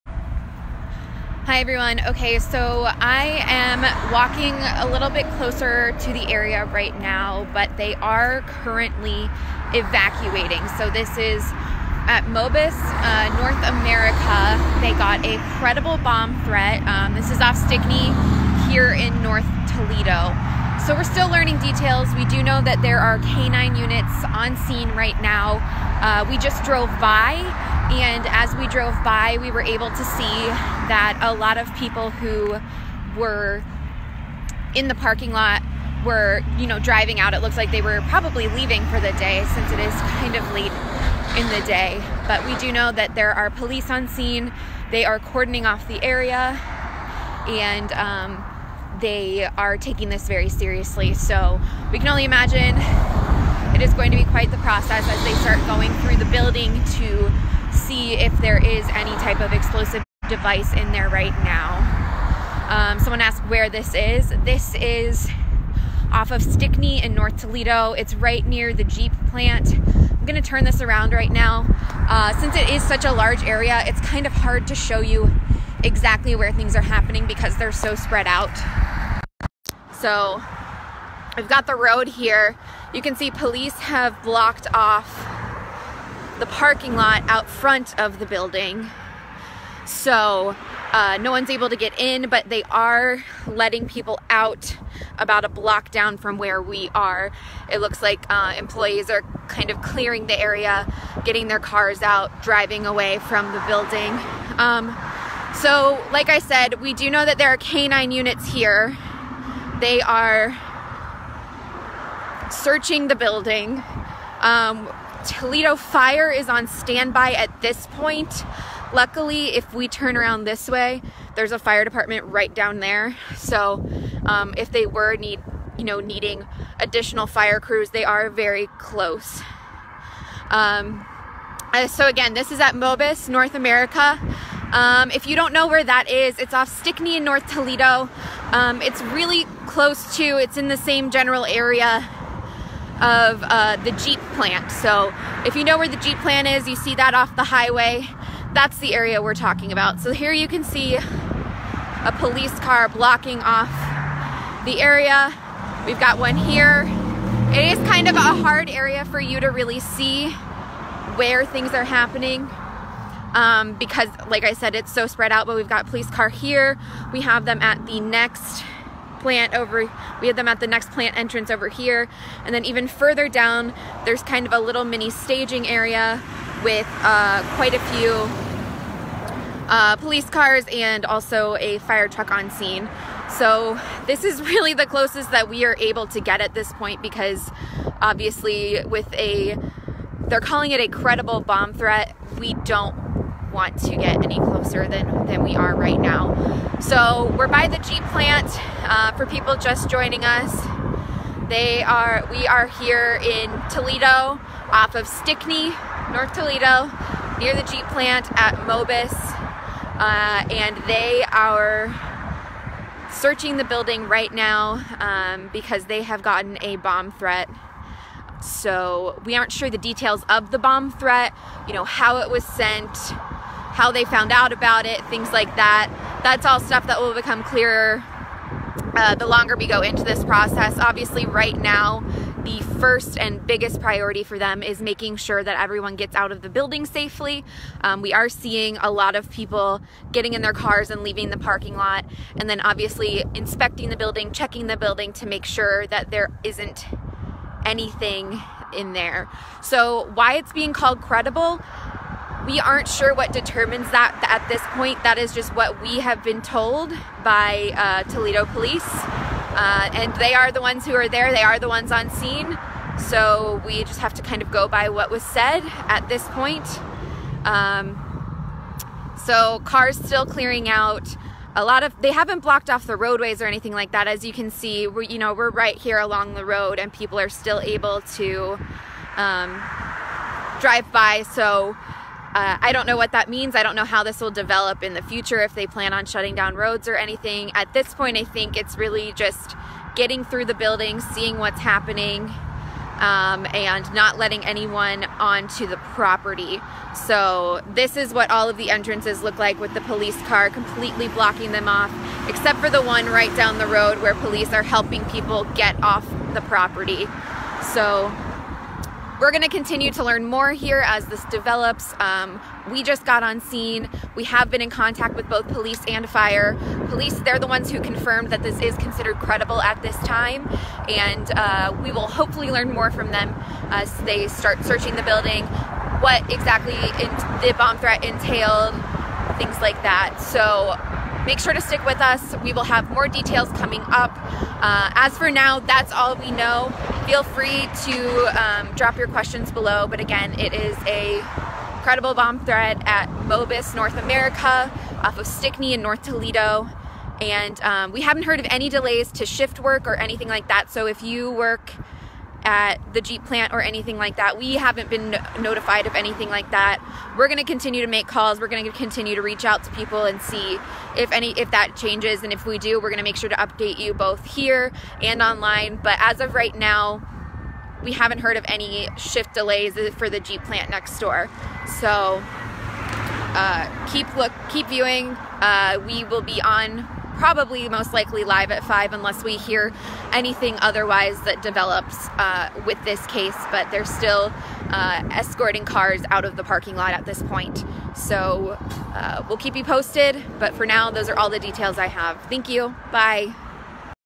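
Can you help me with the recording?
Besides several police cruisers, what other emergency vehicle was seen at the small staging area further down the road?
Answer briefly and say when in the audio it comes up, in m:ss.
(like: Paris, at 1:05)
A fire truck, at 3:01.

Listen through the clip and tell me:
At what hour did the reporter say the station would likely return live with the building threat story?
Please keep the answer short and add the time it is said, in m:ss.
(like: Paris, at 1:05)
5, at 6:18.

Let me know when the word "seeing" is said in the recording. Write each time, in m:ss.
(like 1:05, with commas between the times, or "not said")
3:58, 4:51.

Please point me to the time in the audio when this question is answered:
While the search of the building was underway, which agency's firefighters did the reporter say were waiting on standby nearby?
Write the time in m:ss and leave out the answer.
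1:55.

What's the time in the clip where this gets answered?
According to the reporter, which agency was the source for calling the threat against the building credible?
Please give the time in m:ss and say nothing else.
4:18.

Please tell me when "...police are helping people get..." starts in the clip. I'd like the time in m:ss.
5:04.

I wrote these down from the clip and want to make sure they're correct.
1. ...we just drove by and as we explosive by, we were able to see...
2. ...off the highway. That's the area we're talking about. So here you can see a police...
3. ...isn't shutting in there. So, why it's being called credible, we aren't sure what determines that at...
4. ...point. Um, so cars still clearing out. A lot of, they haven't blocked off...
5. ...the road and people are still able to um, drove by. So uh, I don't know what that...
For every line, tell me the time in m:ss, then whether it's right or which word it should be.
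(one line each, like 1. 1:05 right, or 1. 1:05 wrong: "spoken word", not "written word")
1. 0:26 wrong: "drove", not "explosive"
2. 2:27 right
3. 4:06 wrong: "anything", not "shutting"
4. 4:26 right
5. 4:36 wrong: "drive", not "drove".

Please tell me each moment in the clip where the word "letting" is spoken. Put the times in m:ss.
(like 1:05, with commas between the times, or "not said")
1:33, 4:54.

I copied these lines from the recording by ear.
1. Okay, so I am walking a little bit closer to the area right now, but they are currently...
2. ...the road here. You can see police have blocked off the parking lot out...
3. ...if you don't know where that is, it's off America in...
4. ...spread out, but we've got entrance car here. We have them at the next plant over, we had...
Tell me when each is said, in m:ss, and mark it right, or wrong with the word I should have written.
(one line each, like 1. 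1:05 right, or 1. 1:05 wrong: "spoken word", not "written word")
1. 0:02 right
2. 1:21 right
3. 2:15 wrong: "Stickney", not "America"
4. 2:45 wrong: "police", not "entrance".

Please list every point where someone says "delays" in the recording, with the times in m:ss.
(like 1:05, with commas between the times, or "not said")
5:48, 6:09.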